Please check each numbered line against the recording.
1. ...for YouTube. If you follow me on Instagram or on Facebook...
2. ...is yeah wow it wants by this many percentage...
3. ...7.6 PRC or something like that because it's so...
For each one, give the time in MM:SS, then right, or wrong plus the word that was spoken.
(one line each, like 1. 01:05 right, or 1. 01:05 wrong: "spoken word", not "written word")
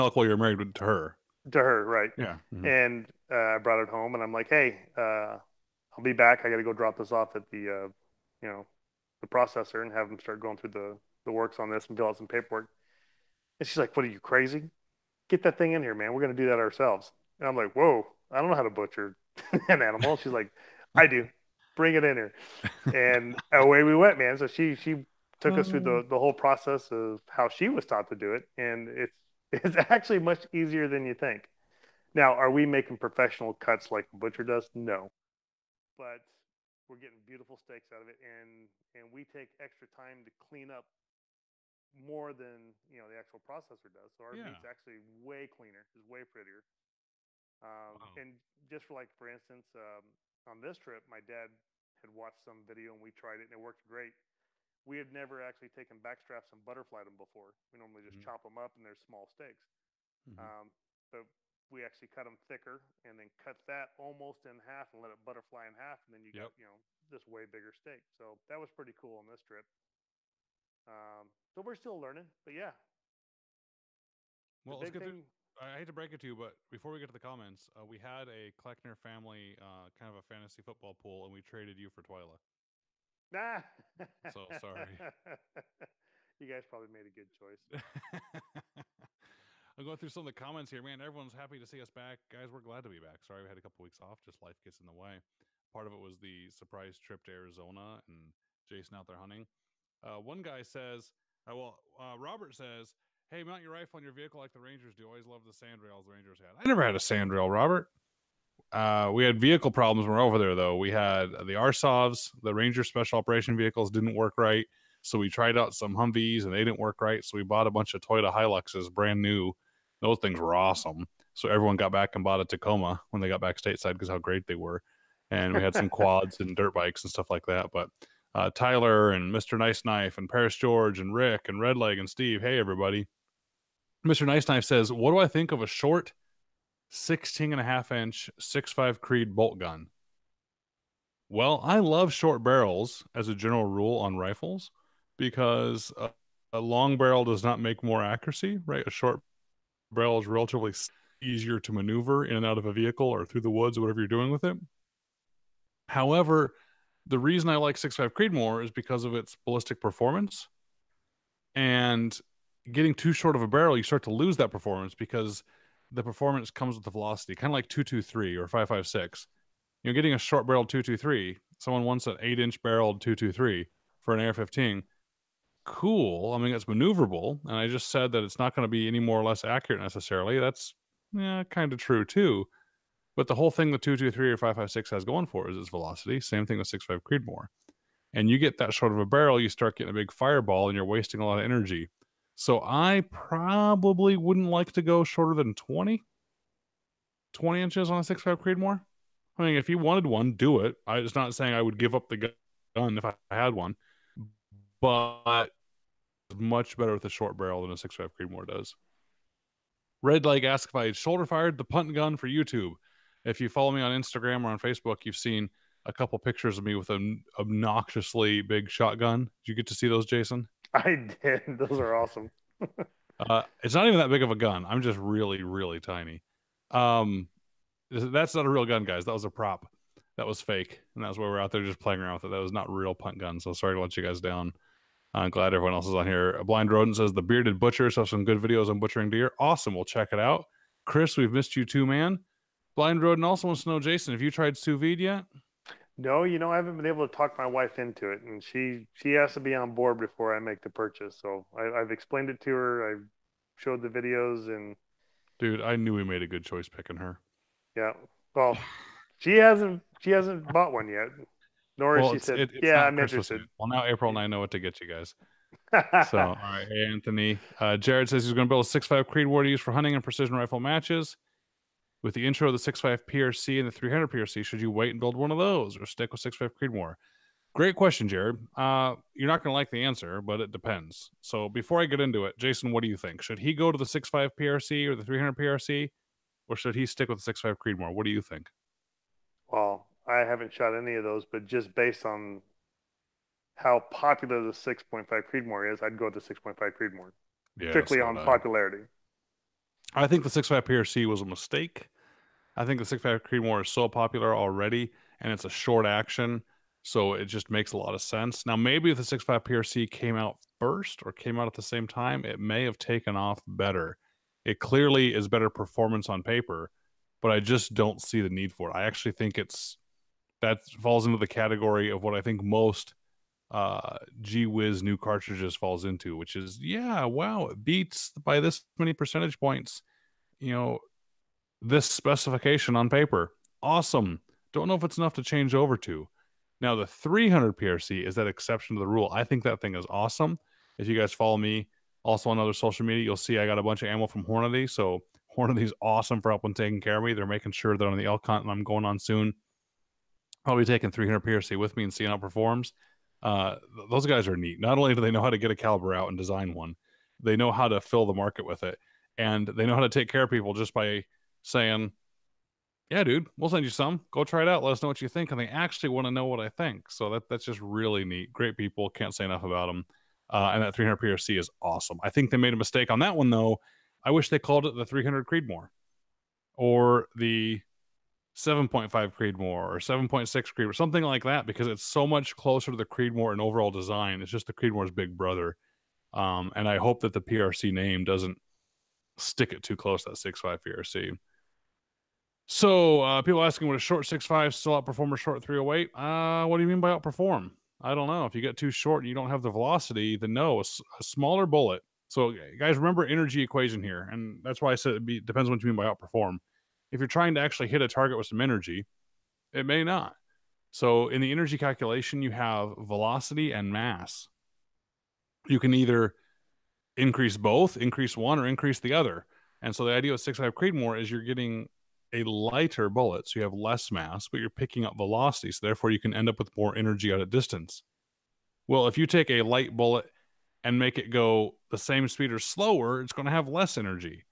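1. 03:32 right
2. 05:26 wrong: "beats", not "wants"
3. 06:19 wrong: "Creed", not "PRC".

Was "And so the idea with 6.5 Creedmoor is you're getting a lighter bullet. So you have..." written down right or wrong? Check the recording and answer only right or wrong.
right.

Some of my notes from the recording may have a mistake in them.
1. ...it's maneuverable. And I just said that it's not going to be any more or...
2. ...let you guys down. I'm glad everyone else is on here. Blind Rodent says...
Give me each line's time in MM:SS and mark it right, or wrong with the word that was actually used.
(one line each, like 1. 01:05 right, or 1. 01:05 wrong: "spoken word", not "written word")
1. 02:56 right
2. 03:53 right.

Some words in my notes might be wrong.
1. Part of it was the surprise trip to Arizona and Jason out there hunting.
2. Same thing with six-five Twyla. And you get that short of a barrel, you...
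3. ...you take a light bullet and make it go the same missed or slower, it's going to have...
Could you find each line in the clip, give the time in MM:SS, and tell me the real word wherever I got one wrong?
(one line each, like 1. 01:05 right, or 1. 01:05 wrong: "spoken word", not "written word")
1. 01:35 right
2. 03:06 wrong: "Creedmoor", not "Twyla"
3. 07:08 wrong: "speed", not "missed".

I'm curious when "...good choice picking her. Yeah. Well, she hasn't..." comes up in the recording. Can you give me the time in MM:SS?
04:16.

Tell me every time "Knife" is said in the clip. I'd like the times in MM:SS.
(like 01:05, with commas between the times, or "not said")
02:09, 02:14.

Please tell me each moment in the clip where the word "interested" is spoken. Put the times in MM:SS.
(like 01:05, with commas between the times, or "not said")
04:23.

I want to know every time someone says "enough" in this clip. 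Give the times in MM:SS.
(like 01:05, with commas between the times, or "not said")
05:34, 06:09.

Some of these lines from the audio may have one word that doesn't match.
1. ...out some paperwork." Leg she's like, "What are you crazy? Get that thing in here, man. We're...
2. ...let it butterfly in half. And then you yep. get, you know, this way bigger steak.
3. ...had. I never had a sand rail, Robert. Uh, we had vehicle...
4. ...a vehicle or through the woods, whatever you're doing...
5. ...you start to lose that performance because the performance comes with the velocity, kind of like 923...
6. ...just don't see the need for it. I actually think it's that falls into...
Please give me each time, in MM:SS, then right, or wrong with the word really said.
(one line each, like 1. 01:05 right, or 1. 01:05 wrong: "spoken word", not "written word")
1. 00:12 wrong: "And", not "Leg"
2. 01:05 right
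3. 01:46 right
4. 02:32 right
5. 02:43 wrong: "223", not "923"
6. 05:17 right.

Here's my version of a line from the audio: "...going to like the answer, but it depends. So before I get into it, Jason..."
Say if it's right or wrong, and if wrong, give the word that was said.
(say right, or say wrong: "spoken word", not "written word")
right.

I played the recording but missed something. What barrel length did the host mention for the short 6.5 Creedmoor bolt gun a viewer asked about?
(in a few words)
16.5 inches.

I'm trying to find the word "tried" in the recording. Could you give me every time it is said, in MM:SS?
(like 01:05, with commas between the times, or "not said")
00:53, 01:55, 04:04.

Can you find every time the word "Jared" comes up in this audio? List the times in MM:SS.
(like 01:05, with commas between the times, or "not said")
04:27, 04:38.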